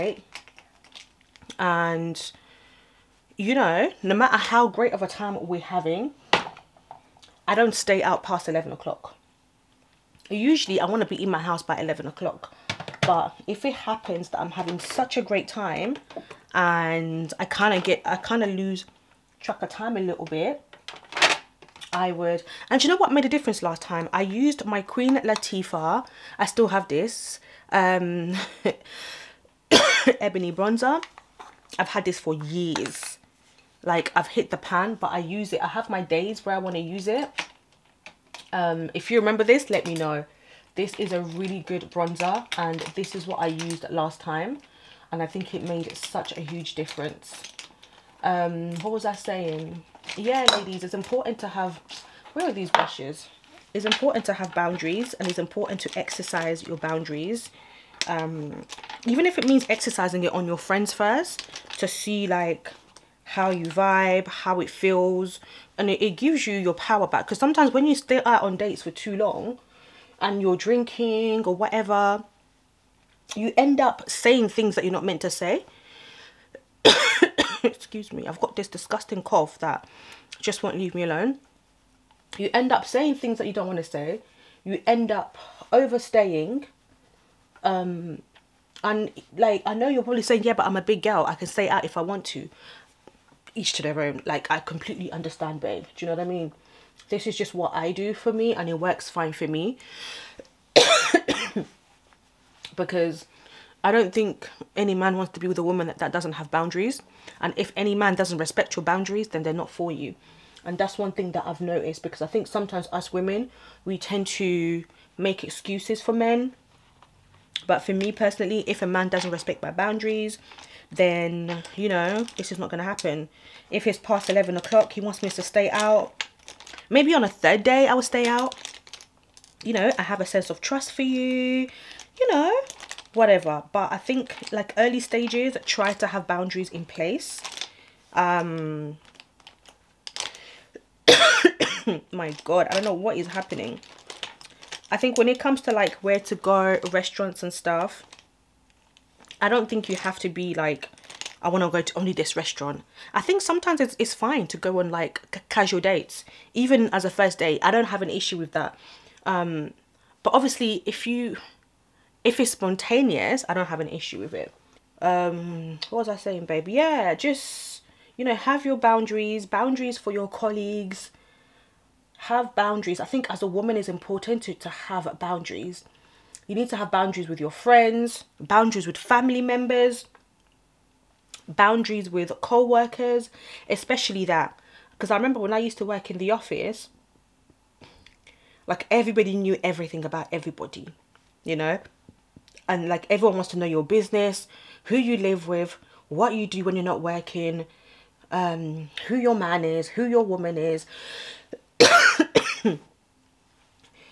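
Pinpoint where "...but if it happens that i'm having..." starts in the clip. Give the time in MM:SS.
00:13.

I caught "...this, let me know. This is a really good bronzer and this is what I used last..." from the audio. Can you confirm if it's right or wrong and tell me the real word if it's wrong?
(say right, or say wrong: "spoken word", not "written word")
right.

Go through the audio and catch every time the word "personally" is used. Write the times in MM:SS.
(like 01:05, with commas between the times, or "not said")
01:58.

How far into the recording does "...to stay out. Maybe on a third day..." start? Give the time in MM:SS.
02:05.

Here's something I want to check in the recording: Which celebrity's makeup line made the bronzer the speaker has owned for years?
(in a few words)
Queen Latifah.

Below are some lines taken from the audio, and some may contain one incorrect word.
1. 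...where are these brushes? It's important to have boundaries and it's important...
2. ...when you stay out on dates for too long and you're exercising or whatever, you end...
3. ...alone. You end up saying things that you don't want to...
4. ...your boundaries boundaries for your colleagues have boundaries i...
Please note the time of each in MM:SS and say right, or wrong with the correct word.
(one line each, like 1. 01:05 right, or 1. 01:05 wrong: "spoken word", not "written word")
1. 00:52 right
2. 01:07 wrong: "drinking", not "exercising"
3. 01:21 right
4. 02:48 right.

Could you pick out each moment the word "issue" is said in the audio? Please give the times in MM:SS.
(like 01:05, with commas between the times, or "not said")
02:38, 02:43.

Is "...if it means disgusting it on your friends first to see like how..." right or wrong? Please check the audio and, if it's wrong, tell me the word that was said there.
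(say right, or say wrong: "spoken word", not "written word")
wrong: "exercising", not "disgusting".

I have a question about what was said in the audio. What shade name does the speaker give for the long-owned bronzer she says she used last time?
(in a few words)
ebony.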